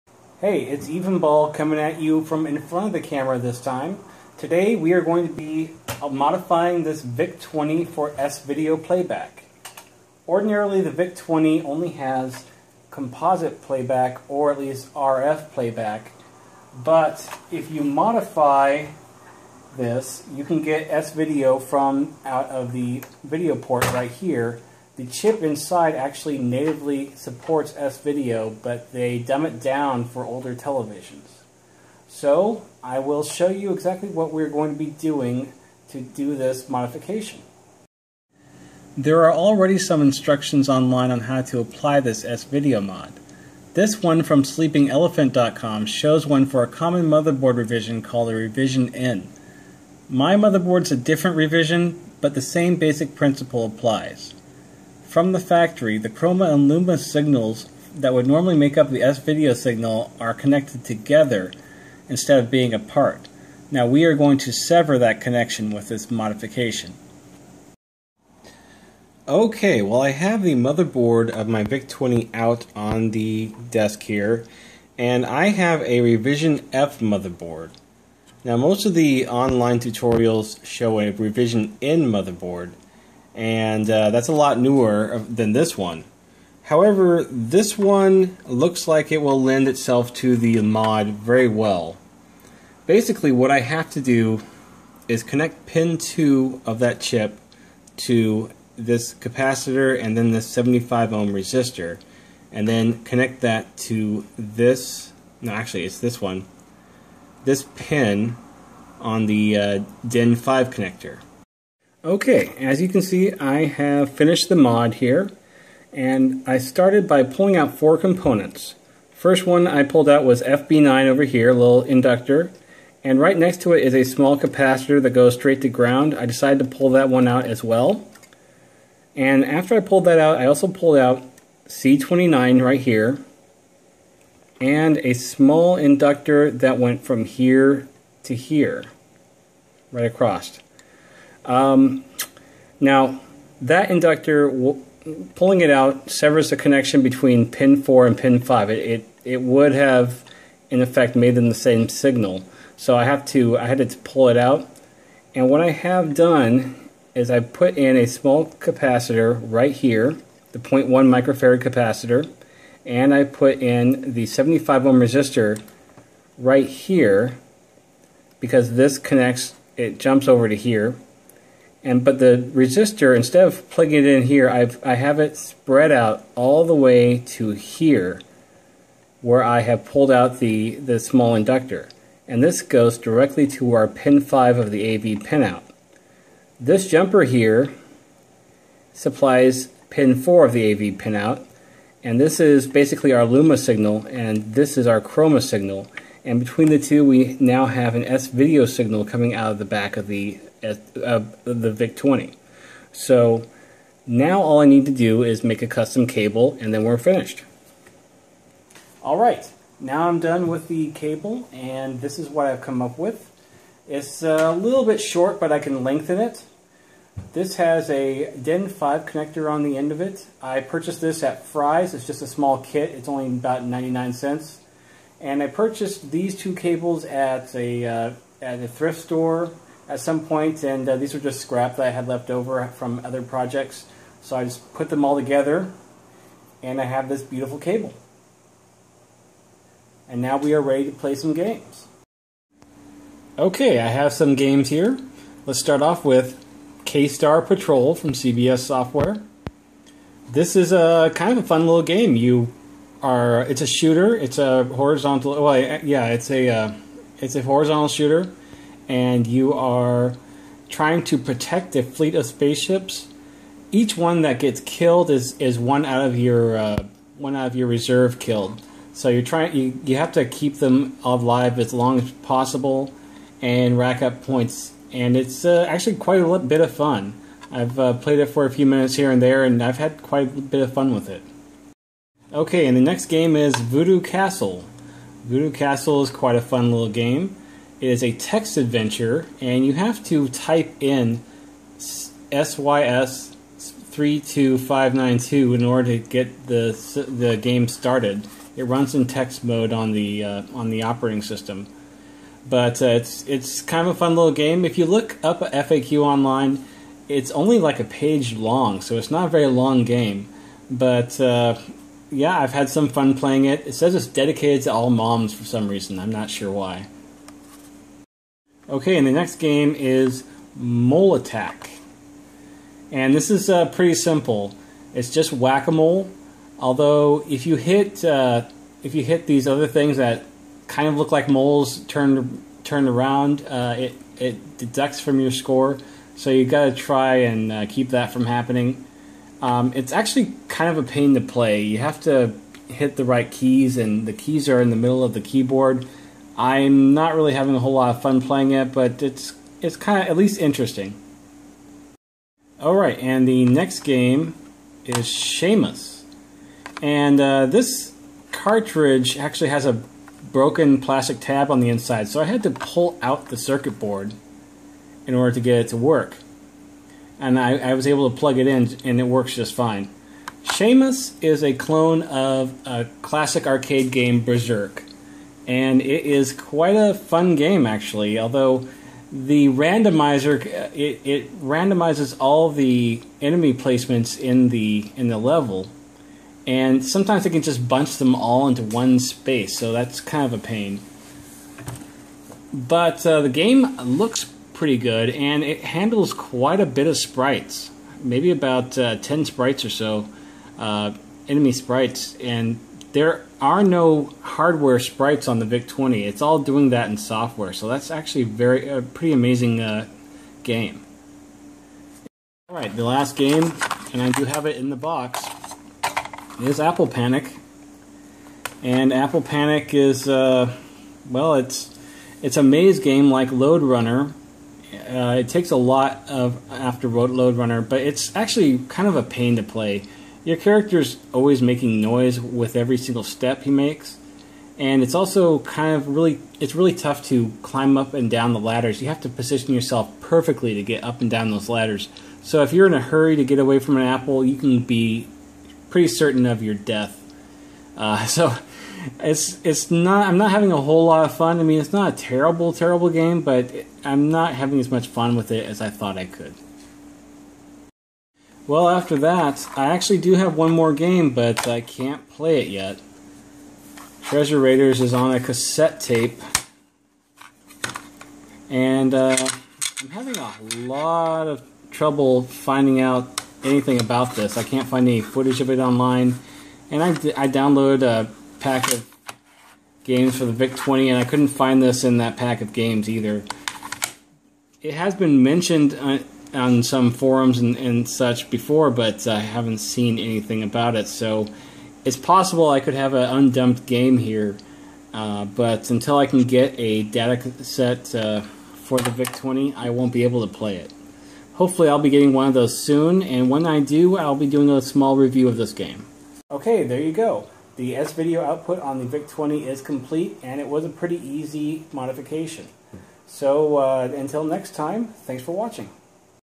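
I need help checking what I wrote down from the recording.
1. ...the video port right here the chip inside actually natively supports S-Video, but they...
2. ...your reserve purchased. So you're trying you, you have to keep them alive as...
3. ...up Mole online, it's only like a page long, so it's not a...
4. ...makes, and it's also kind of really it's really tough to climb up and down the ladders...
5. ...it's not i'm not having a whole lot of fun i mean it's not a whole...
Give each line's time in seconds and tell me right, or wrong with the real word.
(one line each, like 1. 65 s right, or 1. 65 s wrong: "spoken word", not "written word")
1. 22 s right
2. 267 s wrong: "killed", not "purchased"
3. 305 s wrong: "FAQ", not "Mole"
4. 433 s right
5. 449 s wrong: "terrible", not "whole".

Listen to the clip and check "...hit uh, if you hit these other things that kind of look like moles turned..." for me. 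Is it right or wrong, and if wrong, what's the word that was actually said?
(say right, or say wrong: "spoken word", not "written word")
right.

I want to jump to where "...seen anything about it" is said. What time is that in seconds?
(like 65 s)
489 s.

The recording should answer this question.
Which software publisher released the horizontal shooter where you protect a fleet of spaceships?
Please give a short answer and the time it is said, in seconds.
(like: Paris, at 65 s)
CBS Software, at 248 s.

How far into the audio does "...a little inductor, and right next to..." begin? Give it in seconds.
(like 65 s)
121 s.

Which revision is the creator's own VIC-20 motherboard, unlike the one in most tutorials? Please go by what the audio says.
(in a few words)
Revision F.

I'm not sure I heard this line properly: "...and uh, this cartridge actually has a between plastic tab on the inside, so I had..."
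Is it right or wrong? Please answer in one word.
wrong.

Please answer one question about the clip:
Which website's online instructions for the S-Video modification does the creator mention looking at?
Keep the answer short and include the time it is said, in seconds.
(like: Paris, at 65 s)
sleepingelephant.com, at 44 s.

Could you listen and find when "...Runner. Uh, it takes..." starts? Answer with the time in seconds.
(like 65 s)
423 s.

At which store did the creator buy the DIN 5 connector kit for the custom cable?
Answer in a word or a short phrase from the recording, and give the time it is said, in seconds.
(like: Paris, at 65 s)
Fry's, at 221 s.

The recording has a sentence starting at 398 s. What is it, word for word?
Maybe about uh, ten sprites or so, uh, enemy sprites, and there are no hardware sprites on the VIC-20.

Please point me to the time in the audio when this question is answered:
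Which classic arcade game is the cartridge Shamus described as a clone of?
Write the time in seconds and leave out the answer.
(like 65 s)
374 s.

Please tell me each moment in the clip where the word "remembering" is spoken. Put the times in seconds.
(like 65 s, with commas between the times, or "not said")
not said.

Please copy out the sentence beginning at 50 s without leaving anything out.
My motherboard's a different revision, but the same basic principle applies.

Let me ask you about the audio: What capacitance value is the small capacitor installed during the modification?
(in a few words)
0.1 microfarad.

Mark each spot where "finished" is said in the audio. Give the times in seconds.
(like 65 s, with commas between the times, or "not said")
114 s, 206 s.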